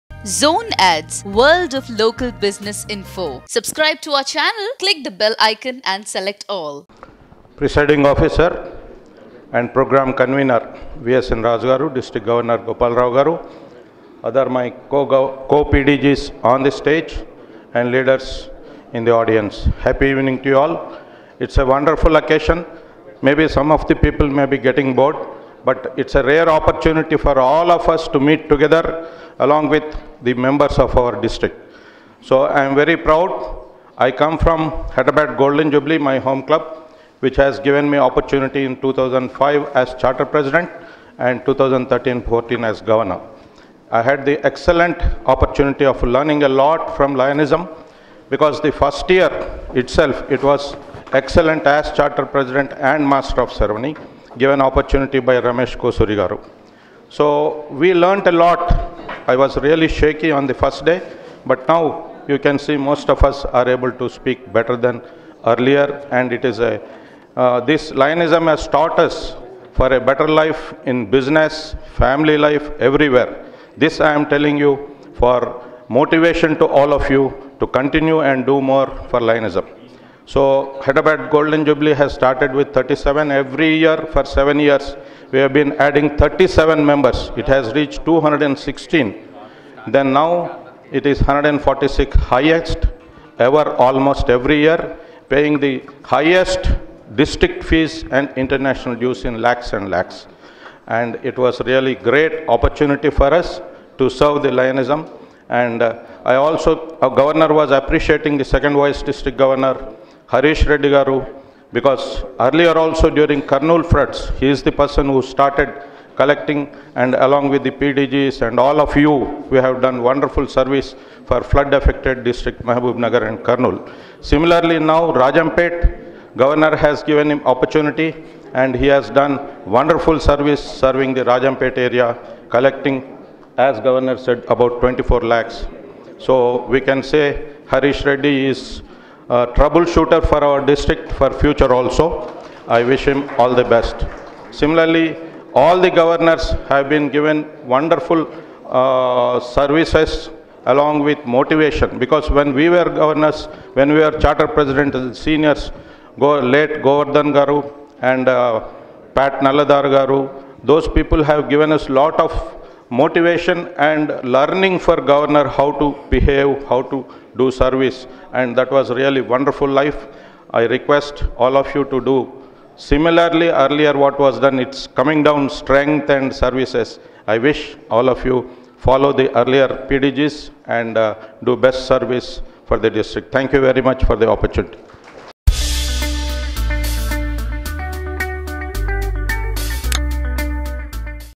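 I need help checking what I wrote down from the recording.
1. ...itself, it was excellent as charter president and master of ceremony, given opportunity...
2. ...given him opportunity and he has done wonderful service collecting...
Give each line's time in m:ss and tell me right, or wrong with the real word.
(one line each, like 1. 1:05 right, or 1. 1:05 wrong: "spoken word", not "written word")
1. 0:49 right
2. 2:07 wrong: "serving", not "collecting".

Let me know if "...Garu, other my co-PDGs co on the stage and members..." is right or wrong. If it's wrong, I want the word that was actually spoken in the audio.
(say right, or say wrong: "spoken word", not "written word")
wrong: "leaders", not "members".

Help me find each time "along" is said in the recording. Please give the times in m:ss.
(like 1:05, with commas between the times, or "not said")
0:29, 1:57, 2:30.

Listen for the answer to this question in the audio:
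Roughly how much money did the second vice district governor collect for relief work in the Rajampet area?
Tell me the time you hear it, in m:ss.
2:14.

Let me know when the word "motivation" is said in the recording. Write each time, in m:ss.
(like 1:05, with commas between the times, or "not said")
1:15, 2:31, 2:42.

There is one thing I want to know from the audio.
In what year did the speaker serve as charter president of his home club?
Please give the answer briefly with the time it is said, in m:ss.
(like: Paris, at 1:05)
2005, at 0:38.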